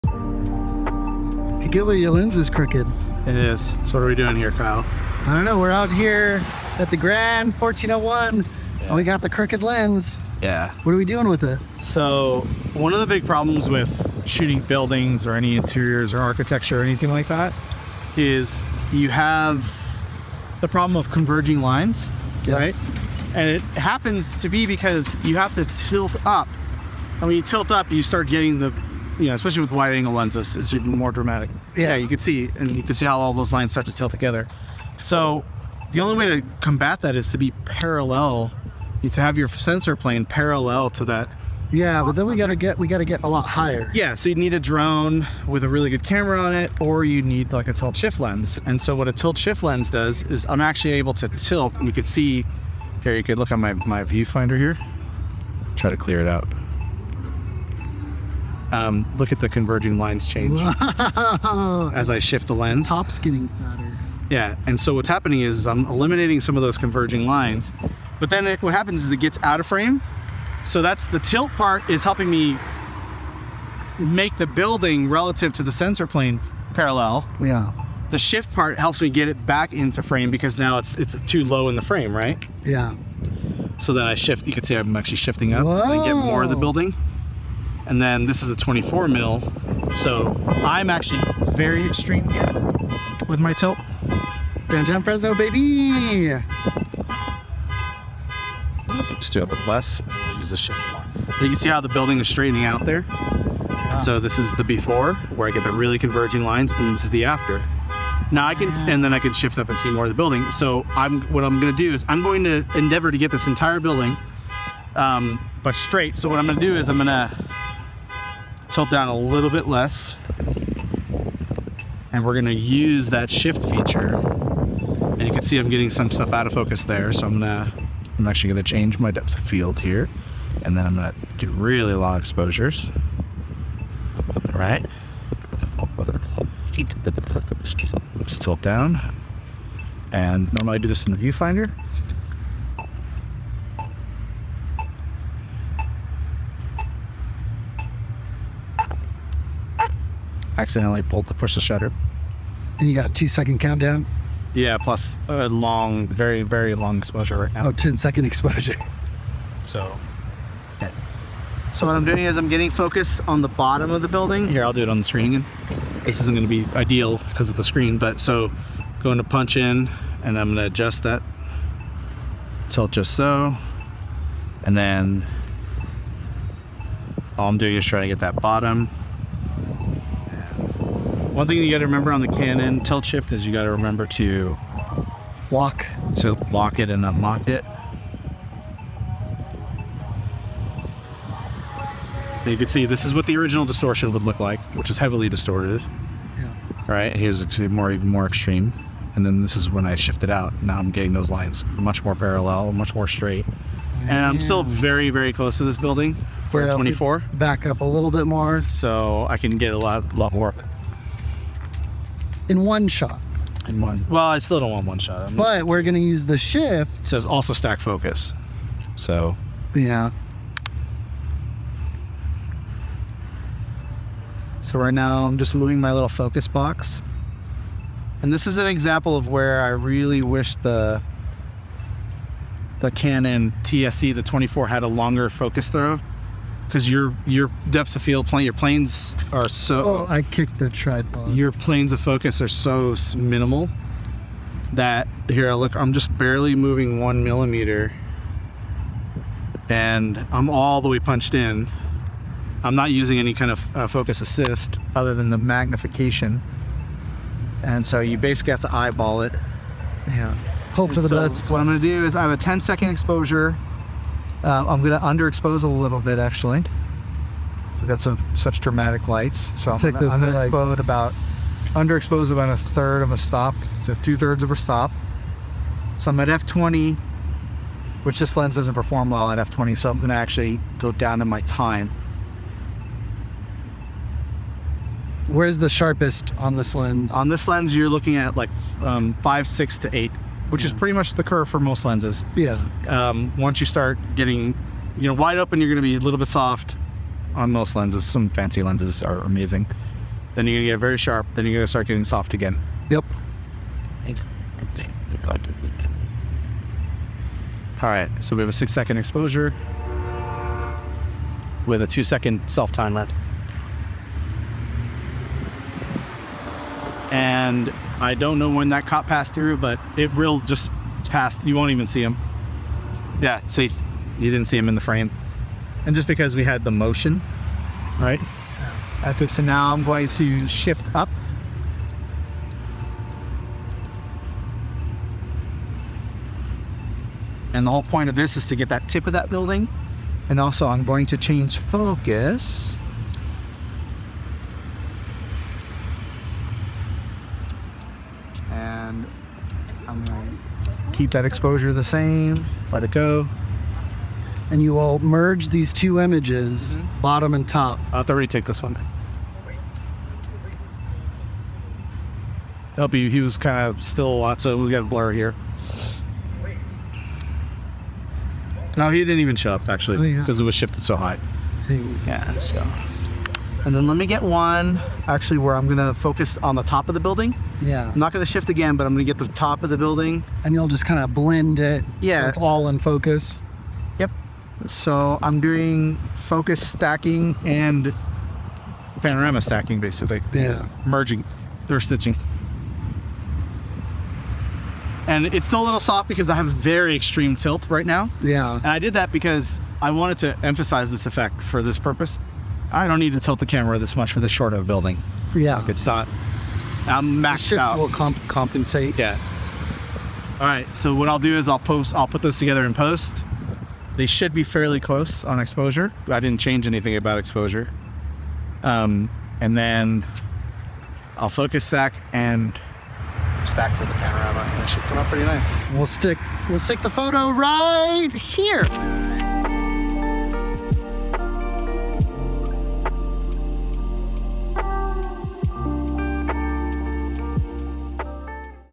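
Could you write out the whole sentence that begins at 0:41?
Yeah, but then we gotta get we gotta get a lot higher.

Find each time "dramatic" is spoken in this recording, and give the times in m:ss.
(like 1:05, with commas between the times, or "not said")
0:31, 4:28.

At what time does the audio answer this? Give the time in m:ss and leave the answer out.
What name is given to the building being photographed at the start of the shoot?
0:06.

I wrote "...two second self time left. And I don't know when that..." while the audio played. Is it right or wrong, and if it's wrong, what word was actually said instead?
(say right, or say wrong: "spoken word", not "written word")
right.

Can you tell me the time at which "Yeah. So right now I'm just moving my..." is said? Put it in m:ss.
3:39.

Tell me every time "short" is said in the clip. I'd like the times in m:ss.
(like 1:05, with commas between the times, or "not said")
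6:44.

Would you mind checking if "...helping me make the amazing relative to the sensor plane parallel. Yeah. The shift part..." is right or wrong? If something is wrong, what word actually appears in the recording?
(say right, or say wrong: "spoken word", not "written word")
wrong: "building", not "amazing".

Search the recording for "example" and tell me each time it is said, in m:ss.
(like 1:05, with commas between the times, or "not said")
3:48.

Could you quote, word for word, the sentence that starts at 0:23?
And it happens to be because you have to tilt up.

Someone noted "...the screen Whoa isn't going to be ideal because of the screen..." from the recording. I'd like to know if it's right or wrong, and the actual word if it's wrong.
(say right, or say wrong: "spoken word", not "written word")
wrong: "This", not "Whoa".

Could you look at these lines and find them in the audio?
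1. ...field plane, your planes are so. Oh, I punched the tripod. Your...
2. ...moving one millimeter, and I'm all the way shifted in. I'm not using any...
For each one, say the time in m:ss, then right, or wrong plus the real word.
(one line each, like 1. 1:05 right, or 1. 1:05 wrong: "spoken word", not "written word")
1. 3:58 wrong: "kicked", not "punched"
2. 4:06 wrong: "punched", not "shifted".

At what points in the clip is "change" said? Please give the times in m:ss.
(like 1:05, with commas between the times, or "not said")
1:00, 2:08, 5:41, 6:56.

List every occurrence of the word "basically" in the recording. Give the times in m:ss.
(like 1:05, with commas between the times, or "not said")
4:18, 6:29.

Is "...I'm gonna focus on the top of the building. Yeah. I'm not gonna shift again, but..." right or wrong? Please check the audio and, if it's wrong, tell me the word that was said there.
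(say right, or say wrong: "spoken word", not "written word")
right.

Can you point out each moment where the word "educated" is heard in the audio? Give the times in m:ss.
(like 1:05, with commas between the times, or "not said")
not said.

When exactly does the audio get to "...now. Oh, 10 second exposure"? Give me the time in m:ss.
2:37.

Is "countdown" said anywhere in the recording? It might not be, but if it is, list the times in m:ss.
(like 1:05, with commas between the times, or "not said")
2:33.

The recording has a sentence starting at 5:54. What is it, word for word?
And you will merge these two images, mm -hmm.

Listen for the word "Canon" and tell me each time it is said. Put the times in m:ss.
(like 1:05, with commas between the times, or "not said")
3:02, 3:52.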